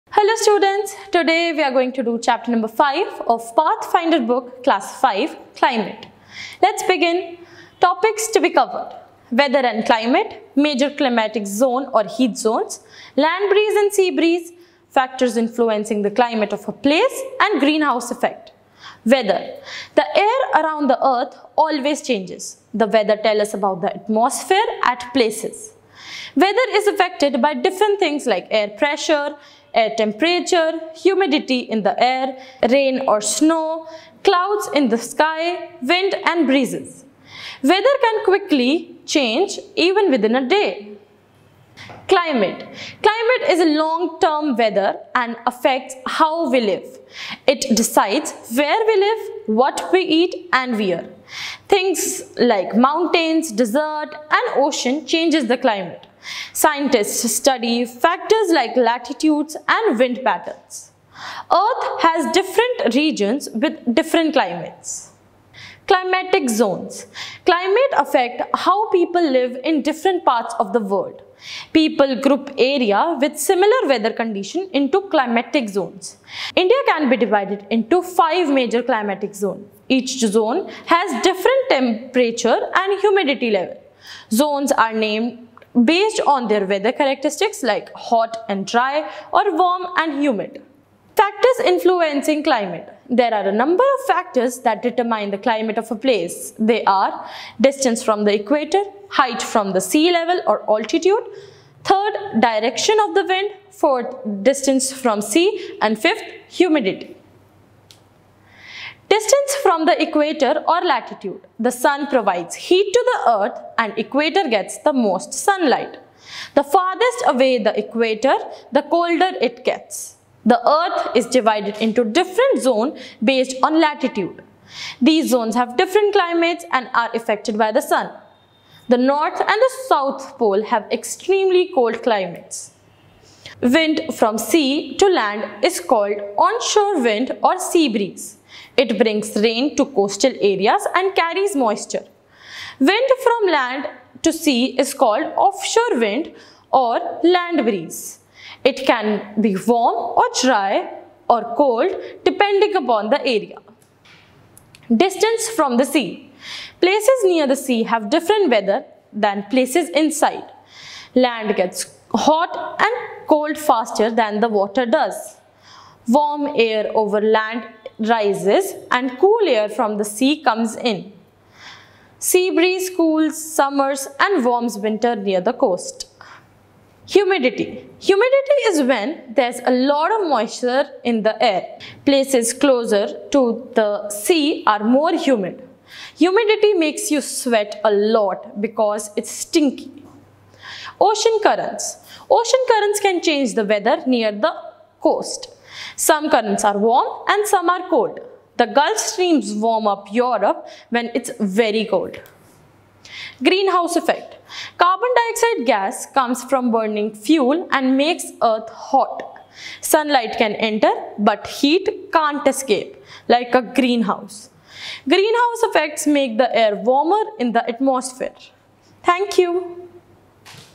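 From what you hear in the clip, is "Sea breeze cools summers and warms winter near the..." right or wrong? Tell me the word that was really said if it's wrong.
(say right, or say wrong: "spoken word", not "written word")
right.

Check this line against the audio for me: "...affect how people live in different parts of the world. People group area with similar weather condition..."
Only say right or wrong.
right.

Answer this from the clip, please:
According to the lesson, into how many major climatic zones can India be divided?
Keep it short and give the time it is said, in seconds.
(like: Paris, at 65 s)
5, at 78 s.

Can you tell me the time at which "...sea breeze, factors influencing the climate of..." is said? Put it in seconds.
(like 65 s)
13 s.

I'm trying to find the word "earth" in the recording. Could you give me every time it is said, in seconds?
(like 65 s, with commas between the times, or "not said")
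21 s, 61 s, 113 s, 120 s, 208 s.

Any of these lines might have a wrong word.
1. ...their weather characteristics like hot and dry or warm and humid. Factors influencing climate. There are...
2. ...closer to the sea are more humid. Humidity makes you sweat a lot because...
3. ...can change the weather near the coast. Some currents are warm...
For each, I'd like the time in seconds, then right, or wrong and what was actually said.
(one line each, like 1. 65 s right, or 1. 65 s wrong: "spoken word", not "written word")
1. 86 s right
2. 182 s right
3. 192 s right.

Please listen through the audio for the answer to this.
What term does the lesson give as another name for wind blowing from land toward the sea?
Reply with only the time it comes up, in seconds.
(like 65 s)
145 s.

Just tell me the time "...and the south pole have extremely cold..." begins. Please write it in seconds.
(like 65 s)
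129 s.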